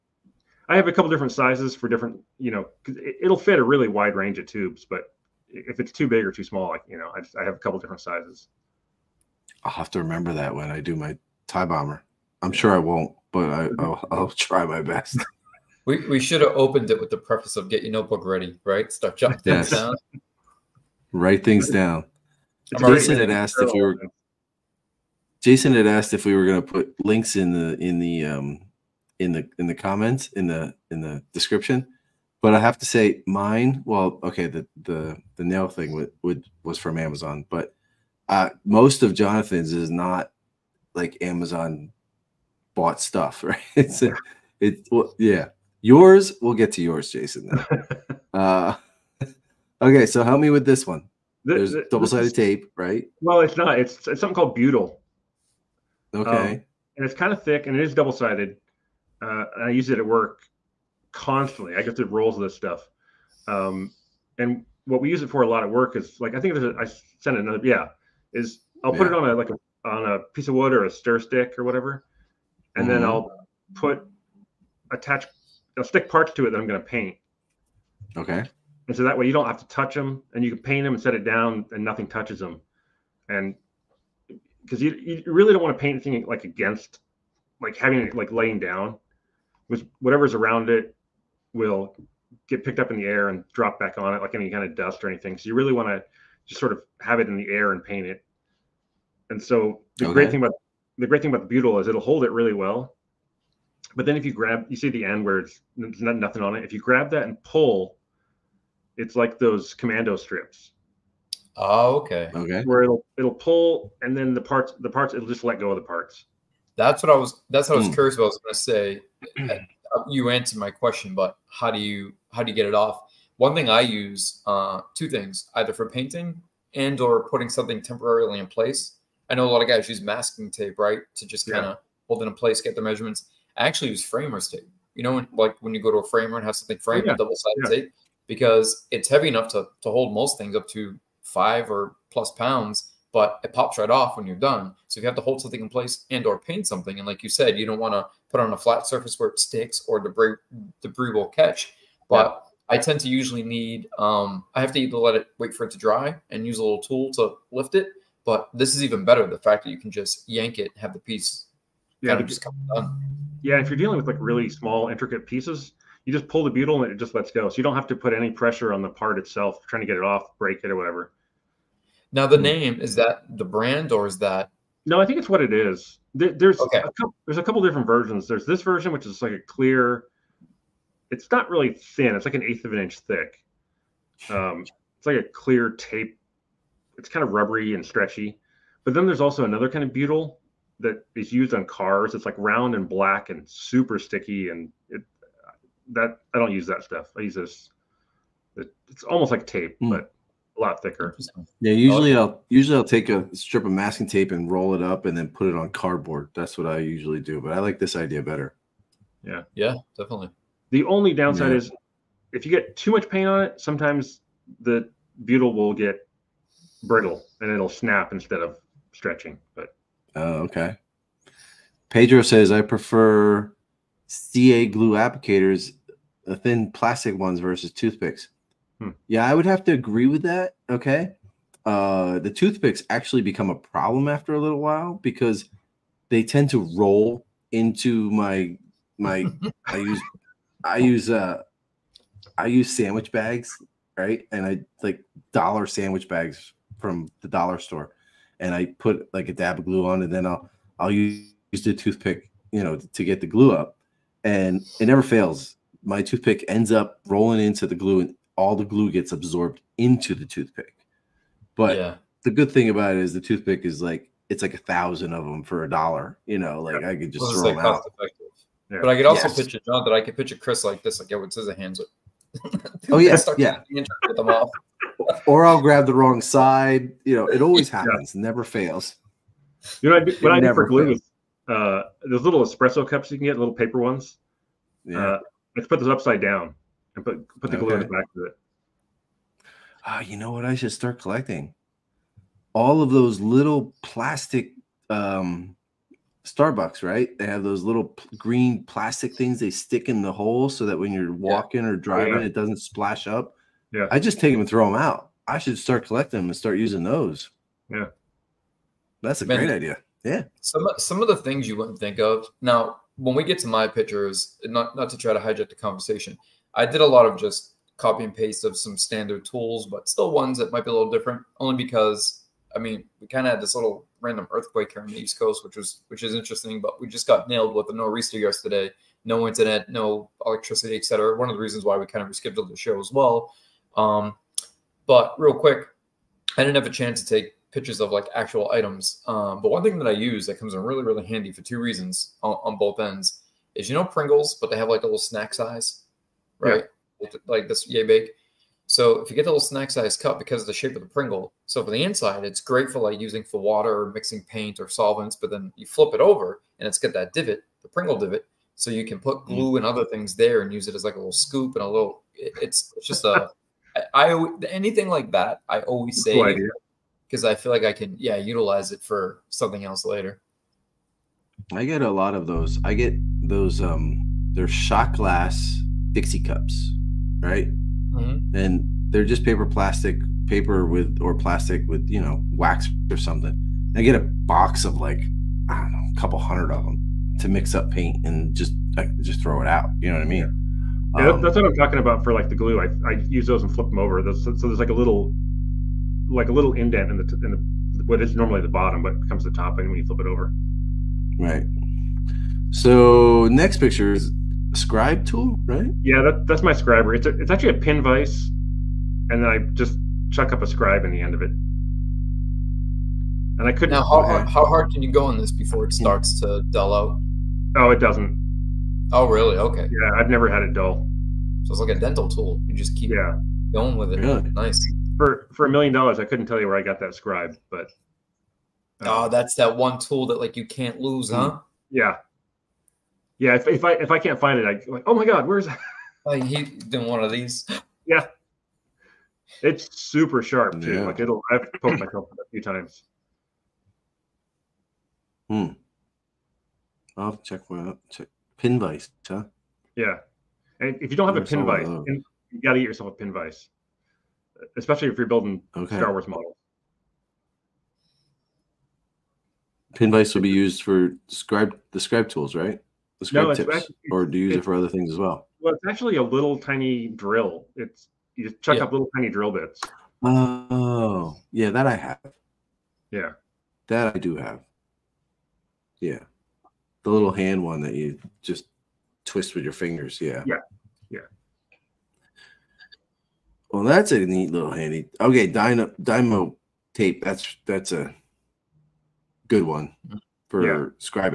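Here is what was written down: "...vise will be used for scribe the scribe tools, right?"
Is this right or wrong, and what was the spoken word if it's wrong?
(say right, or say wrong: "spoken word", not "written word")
right.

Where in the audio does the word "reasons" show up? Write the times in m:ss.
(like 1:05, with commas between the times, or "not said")
5:31, 5:41.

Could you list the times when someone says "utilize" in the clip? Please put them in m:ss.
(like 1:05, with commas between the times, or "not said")
6:08.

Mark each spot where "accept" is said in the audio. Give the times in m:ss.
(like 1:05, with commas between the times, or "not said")
not said.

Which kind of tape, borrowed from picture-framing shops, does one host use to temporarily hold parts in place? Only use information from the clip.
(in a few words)
Framer's tape.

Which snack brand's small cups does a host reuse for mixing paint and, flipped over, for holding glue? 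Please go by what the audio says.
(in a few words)
Pringles.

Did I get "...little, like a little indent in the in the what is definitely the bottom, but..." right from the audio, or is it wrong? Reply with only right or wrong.
wrong.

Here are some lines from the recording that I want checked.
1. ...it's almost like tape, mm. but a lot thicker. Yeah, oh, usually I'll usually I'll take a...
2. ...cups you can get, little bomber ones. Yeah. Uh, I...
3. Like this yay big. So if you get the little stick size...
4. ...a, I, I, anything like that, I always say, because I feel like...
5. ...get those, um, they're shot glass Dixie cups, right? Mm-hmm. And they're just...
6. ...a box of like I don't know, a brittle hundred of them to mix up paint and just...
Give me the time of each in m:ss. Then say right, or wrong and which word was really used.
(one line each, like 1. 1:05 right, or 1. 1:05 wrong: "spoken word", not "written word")
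1. 3:18 right
2. 4:42 wrong: "paper", not "bomber"
3. 5:47 wrong: "snack", not "stick"
4. 6:03 right
5. 6:12 right
6. 6:23 wrong: "couple", not "brittle".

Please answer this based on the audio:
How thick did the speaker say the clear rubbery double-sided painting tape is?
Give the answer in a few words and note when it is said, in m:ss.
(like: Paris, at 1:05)
An eighth of an inch, at 3:02.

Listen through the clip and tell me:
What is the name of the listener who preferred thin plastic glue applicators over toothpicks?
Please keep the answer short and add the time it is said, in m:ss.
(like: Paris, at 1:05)
Pedro, at 3:41.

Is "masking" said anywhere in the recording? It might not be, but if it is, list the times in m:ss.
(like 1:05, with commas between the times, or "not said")
2:10, 3:23.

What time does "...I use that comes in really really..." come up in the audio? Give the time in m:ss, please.
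5:39.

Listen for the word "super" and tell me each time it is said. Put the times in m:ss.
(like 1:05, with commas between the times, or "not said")
3:13, 7:19.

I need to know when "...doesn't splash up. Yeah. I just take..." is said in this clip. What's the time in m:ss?
5:02.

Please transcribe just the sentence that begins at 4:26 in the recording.
I could just well, throw like them out.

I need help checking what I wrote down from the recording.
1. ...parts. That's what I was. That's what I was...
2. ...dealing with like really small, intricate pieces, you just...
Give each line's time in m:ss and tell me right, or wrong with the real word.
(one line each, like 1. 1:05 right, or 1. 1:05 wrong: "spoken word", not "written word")
1. 1:55 right
2. 2:43 right.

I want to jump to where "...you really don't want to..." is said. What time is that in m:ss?
1:24.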